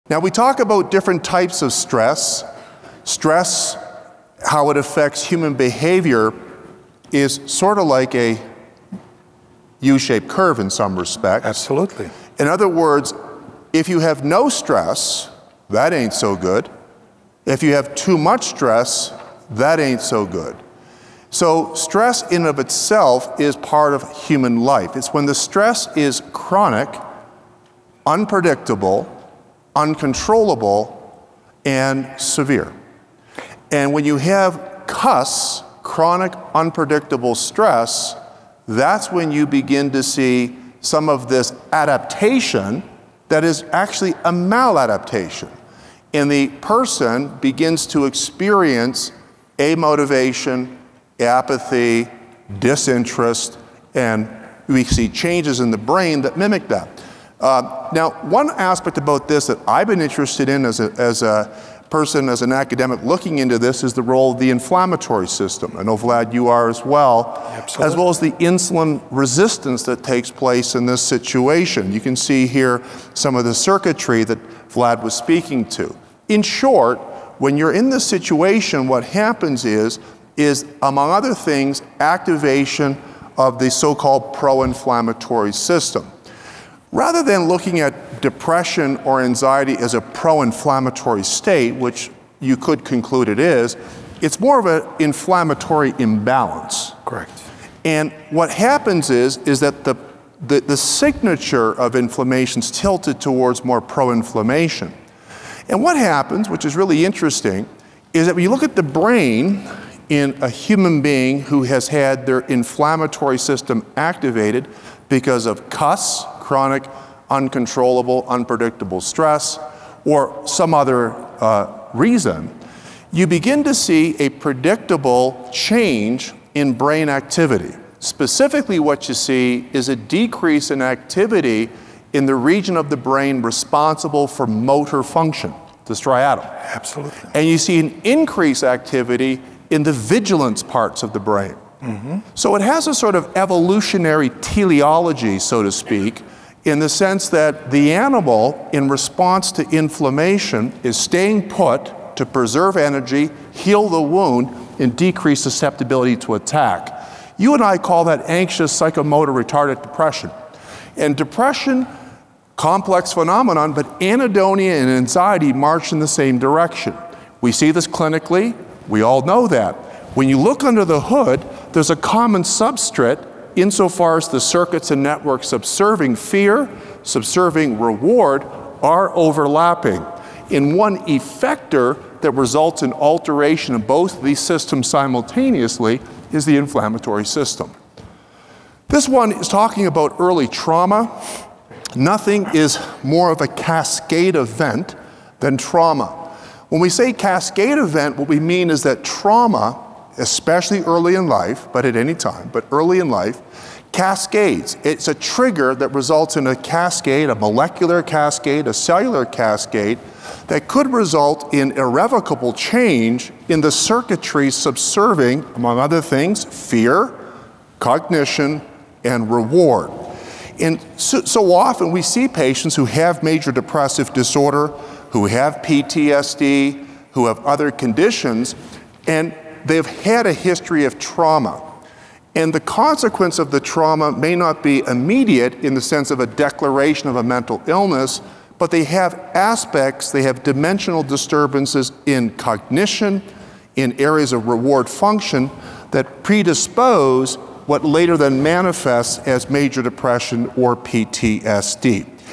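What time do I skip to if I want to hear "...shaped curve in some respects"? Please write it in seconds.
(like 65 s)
9 s.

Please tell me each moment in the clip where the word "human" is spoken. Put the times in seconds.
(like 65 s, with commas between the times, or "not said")
5 s, 24 s, 110 s.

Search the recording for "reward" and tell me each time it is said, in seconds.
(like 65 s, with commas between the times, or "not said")
177 s, 219 s, 244 s.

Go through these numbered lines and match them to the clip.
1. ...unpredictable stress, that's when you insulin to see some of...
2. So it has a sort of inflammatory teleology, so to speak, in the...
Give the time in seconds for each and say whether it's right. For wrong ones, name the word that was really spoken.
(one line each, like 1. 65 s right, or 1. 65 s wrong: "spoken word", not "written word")
1. 36 s wrong: "begin", not "insulin"
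2. 142 s wrong: "evolutionary", not "inflammatory".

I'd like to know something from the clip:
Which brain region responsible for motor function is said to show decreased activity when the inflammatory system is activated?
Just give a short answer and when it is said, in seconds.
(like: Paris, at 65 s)
striatum, at 135 s.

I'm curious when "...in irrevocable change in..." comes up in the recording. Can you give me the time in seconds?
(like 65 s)
211 s.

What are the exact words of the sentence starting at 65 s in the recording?
I know, Vlad, you are as well, Absolutely.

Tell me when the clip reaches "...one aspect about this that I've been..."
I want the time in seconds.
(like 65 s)
58 s.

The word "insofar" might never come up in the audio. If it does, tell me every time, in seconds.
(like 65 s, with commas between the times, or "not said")
173 s.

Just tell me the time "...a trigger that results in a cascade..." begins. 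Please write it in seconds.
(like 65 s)
205 s.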